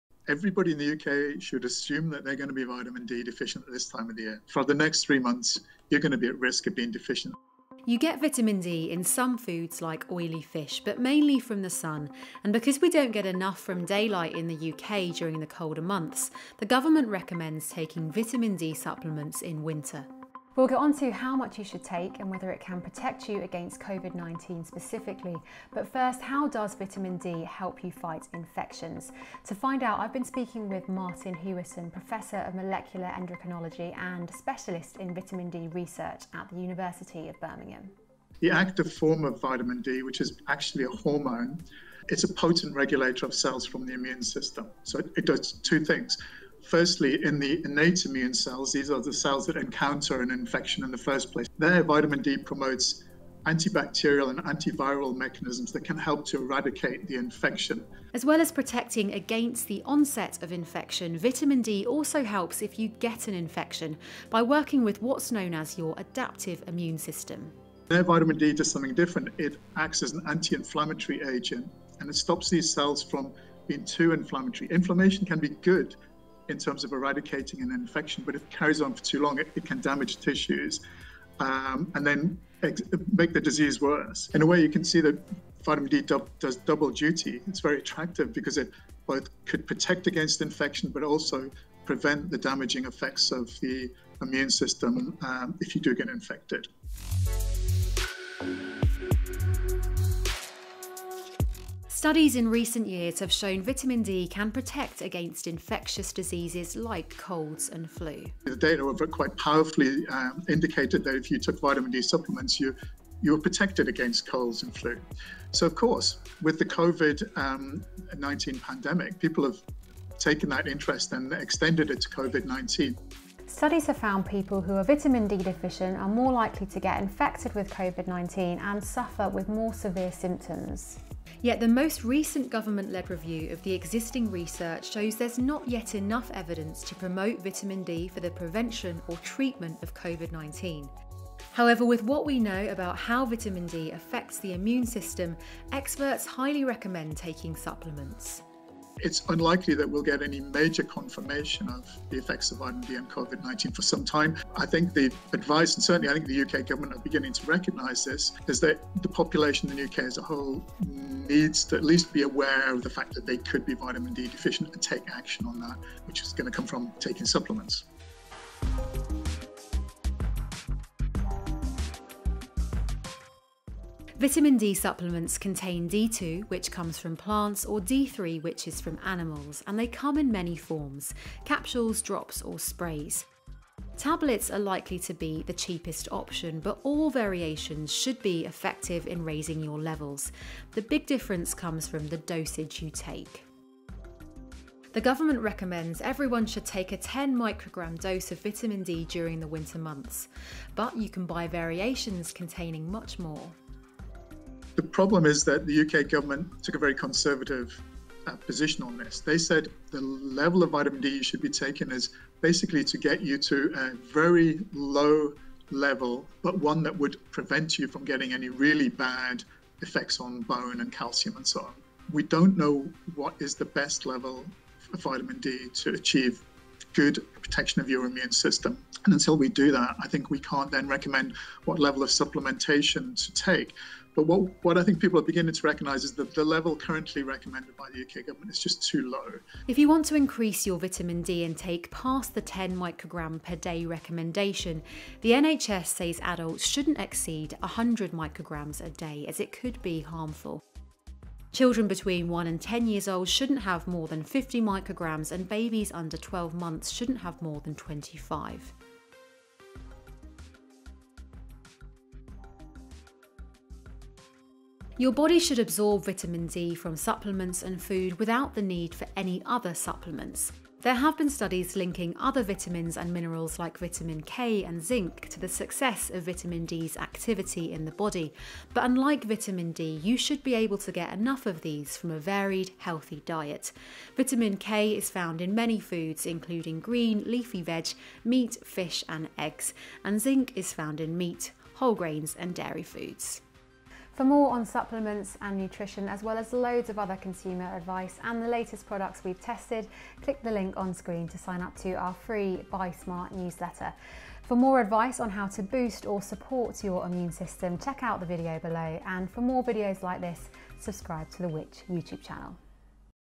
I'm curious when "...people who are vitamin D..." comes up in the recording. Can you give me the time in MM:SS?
02:04.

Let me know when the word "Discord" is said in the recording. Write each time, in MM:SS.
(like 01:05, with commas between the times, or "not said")
not said.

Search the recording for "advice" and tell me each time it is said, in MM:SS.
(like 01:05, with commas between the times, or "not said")
02:35, 04:57, 05:04.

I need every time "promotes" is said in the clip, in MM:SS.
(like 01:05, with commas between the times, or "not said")
00:52, 02:16.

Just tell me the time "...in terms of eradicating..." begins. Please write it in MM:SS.
01:16.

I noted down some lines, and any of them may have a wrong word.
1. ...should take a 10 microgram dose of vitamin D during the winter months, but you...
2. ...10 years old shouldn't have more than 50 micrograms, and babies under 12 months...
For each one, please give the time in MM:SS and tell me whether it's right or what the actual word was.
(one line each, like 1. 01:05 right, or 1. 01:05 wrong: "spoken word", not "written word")
1. 03:16 right
2. 04:12 right.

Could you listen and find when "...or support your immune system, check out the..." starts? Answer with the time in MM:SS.
05:06.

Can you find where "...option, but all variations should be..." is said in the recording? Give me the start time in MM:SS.
03:06.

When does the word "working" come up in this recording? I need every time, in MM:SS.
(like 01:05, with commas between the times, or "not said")
01:04.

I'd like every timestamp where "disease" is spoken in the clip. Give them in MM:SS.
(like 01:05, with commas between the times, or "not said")
01:23, 01:46.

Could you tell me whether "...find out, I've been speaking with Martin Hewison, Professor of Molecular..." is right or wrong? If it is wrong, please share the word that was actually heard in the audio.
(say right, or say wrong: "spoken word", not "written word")
right.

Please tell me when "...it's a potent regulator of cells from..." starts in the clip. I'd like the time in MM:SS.
00:42.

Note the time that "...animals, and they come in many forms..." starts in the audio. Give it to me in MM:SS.
02:59.